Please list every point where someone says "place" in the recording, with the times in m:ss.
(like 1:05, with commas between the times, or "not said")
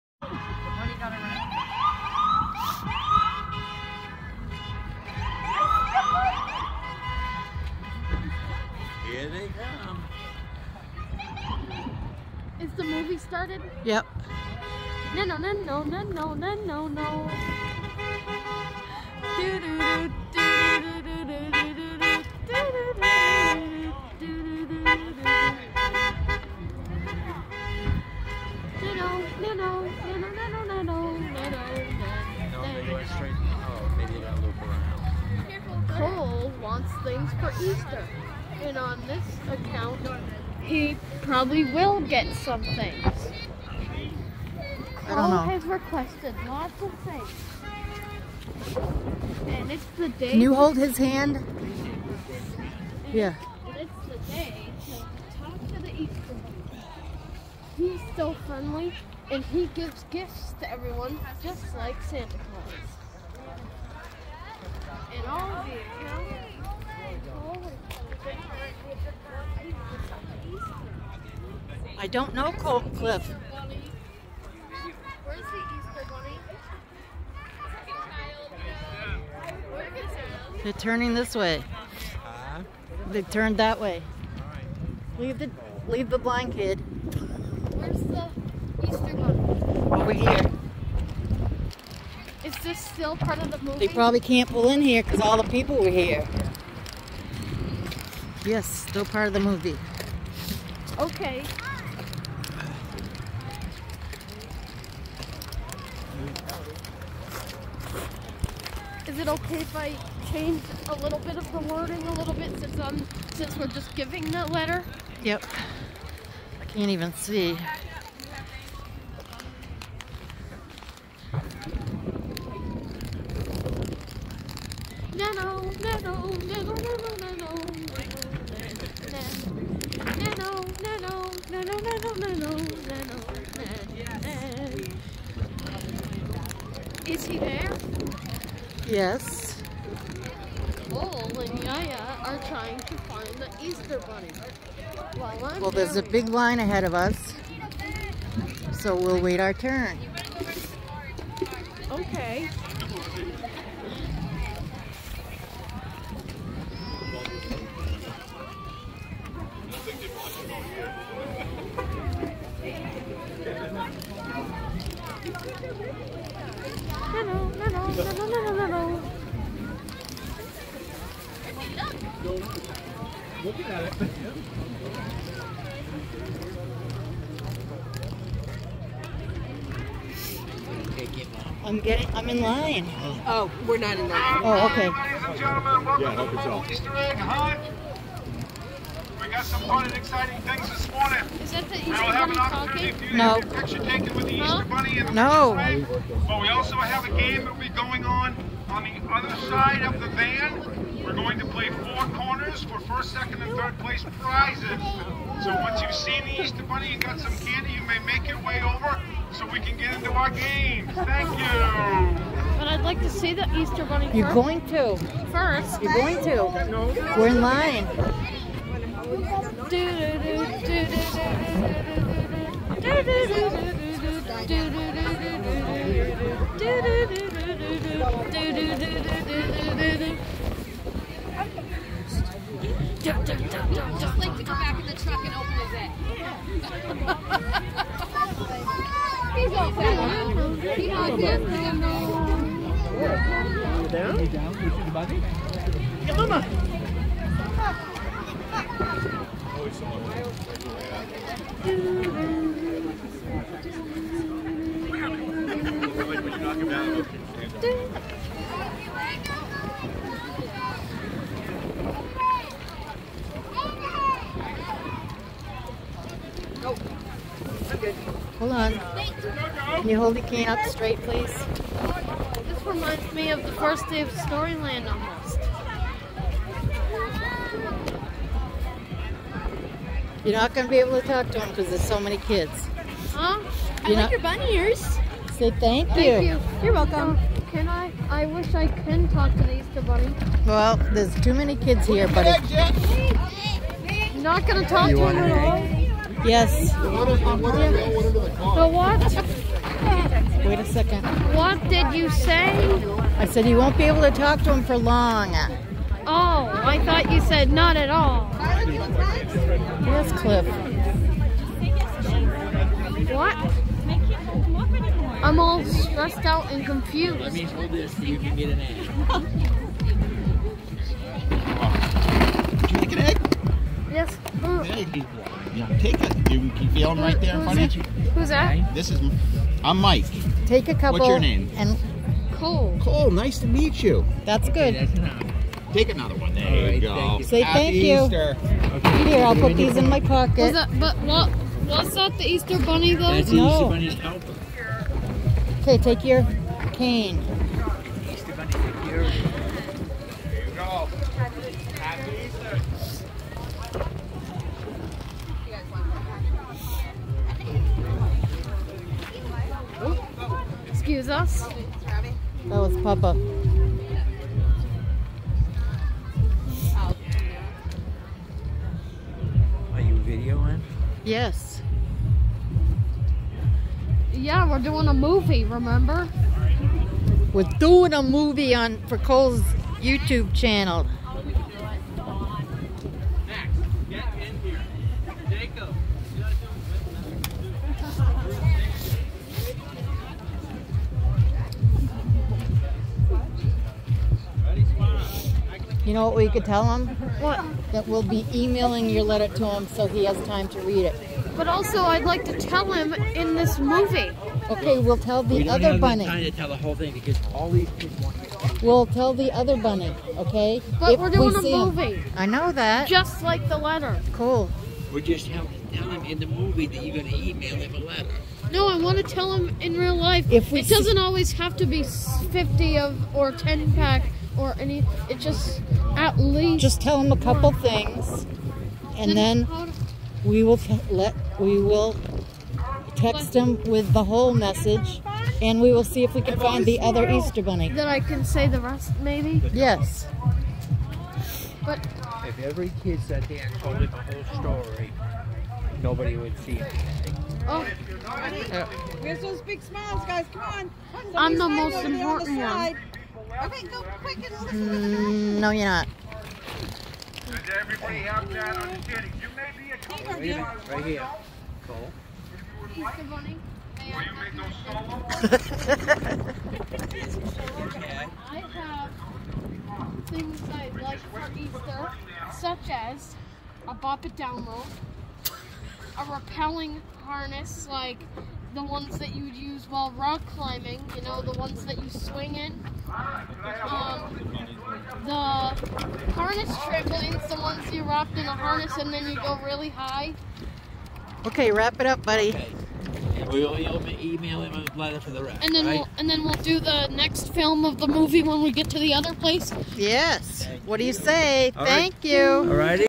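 3:23, 8:19.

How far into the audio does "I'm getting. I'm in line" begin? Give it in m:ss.
3:01.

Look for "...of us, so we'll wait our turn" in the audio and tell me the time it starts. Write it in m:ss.
2:26.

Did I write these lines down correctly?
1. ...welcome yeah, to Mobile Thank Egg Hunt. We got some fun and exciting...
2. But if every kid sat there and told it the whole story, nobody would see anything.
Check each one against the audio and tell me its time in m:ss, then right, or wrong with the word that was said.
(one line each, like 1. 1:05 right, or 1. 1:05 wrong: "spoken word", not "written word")
1. 3:05 wrong: "Easter", not "Thank"
2. 7:21 right.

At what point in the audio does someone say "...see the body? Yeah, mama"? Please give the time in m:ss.
4:04.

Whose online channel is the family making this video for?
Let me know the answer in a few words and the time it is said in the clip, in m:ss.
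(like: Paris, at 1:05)
Cole's YouTube channel, at 6:18.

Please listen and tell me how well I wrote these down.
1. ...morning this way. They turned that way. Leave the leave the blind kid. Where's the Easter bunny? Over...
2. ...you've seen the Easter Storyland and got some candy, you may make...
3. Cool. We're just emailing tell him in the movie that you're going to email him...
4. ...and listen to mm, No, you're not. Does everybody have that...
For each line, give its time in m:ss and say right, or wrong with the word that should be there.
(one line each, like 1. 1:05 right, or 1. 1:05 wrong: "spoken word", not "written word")
1. 1:20 wrong: "turning", not "morning"
2. 3:25 wrong: "Bunny", not "Storyland"
3. 6:54 wrong: "telling", not "emailing"
4. 7:34 right.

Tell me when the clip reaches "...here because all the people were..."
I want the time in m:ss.
1:34.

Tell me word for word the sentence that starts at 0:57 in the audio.
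He's so friendly, and he gives gifts to everyone, just like Santa Claus.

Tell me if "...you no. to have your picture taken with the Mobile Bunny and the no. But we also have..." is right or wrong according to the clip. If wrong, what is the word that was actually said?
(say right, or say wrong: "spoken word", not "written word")
wrong: "Easter", not "Mobile".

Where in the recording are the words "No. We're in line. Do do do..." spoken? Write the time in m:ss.
3:36.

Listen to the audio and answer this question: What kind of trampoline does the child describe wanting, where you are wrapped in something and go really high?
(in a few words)
harness trampolines.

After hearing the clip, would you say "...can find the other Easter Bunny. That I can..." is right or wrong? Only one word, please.
right.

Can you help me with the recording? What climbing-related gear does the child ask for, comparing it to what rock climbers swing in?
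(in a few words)
a repelling harness.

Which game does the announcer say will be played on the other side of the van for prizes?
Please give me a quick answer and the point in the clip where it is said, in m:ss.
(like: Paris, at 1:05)
four corners, at 3:21.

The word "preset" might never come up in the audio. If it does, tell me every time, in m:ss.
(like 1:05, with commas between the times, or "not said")
not said.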